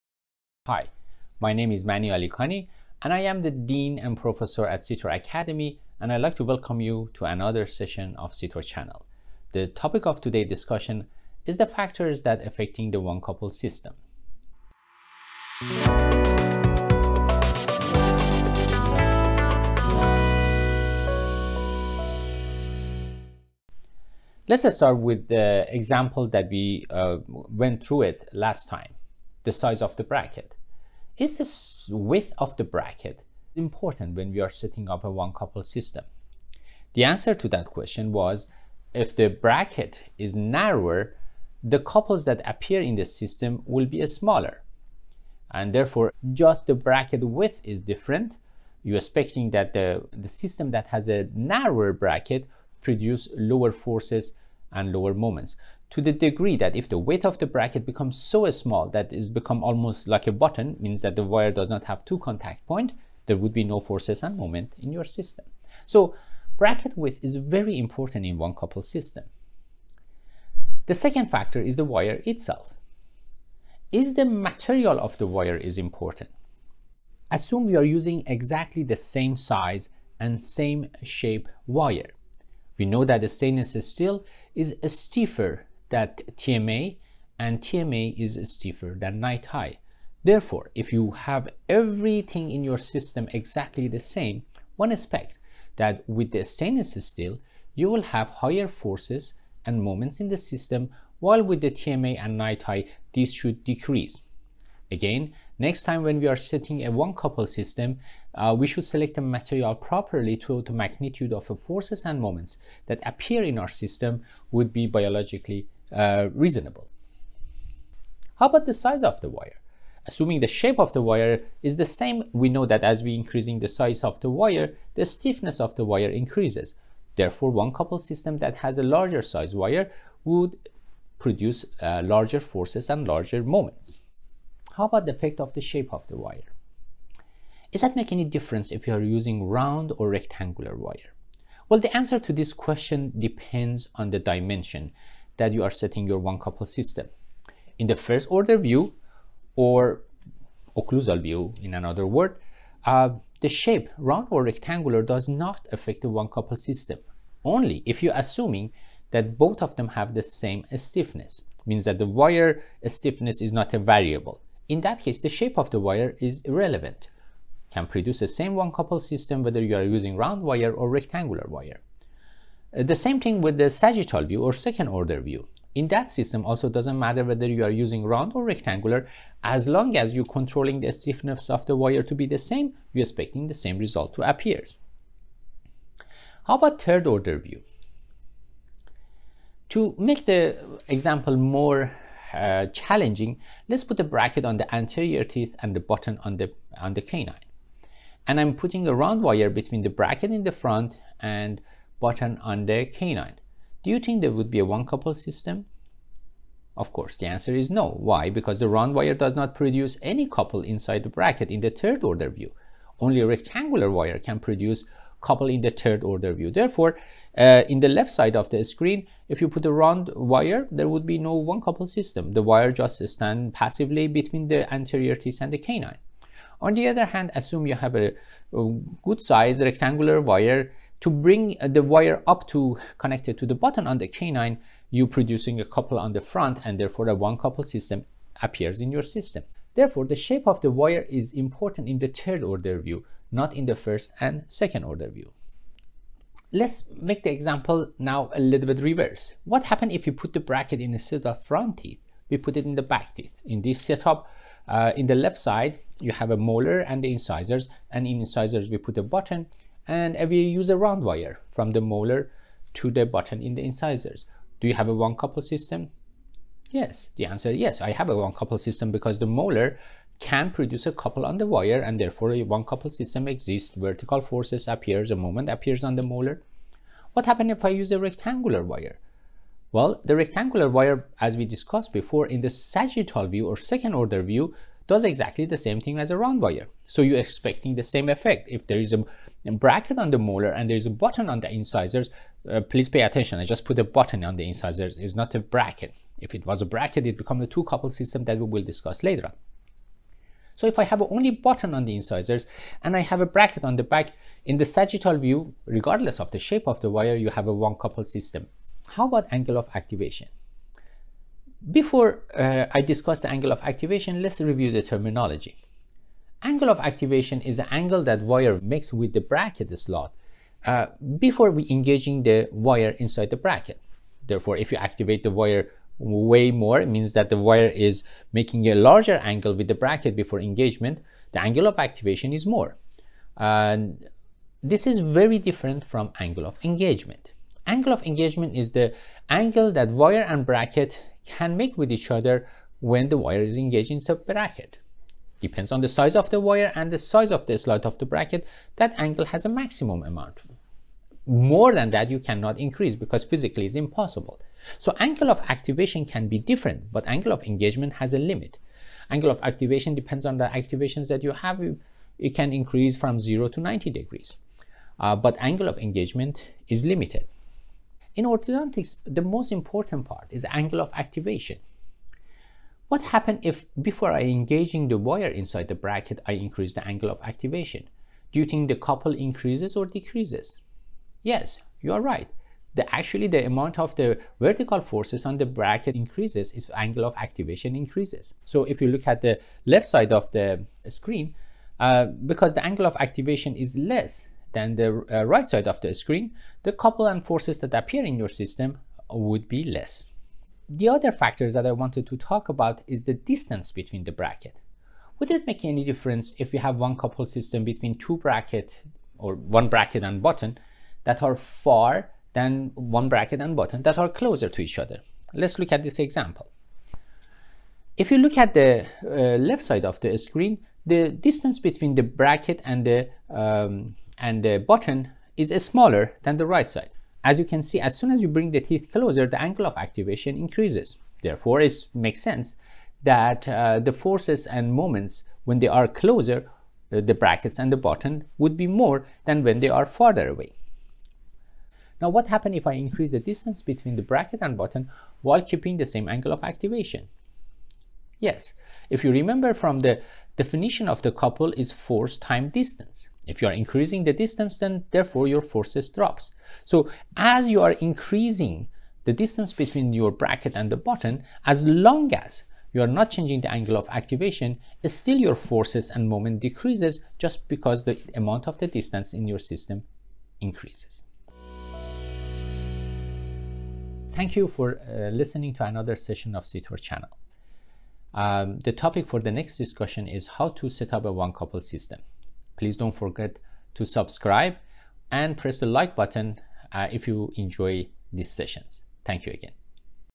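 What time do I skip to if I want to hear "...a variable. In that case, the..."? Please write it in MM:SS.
02:43.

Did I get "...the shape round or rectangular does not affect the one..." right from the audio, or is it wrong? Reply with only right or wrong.
right.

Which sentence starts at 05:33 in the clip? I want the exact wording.
And this is very different from angle of engagement.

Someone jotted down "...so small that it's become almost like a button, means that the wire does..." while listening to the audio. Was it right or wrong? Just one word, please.
right.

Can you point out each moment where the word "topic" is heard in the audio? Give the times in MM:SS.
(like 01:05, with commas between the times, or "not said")
00:09, 07:58.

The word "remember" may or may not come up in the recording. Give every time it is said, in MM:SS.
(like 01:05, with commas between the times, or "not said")
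07:29.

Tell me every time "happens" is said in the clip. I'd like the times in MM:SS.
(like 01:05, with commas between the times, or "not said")
04:09, 04:37, 06:13, 07:22.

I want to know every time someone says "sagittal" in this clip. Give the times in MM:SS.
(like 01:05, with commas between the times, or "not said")
02:53, 04:42, 05:04.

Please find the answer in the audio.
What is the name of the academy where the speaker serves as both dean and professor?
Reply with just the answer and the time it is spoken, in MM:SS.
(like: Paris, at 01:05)
CTOR Academy, at 00:04.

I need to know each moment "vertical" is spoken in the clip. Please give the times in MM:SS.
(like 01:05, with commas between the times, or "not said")
04:33, 06:24.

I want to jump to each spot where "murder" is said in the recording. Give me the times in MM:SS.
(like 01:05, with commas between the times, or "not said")
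not said.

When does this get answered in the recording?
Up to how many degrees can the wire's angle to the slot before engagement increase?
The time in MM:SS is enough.
06:03.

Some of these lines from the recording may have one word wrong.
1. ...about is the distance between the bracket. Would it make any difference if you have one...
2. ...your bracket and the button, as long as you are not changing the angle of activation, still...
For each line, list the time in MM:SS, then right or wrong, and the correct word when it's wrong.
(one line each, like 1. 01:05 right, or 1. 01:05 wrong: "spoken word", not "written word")
1. 06:42 right
2. 07:39 right.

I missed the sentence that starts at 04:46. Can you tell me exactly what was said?
So you're expecting the same effect.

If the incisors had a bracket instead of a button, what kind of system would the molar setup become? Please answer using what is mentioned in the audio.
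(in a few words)
2 couple system.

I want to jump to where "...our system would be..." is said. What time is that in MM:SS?
01:53.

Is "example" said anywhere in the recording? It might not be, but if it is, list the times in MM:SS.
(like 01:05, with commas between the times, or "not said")
00:25, 03:10, 04:07, 06:55.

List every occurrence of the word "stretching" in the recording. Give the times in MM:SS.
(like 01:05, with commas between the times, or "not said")
not said.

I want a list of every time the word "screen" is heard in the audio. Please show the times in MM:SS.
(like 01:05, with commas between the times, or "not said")
03:38, 06:30, 06:35, 07:00.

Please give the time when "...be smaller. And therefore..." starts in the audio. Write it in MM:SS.
00:43.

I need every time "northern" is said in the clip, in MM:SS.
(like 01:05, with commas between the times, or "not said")
not said.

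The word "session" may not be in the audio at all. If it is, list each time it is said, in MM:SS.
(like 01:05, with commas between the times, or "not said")
00:07, 07:55, 08:08.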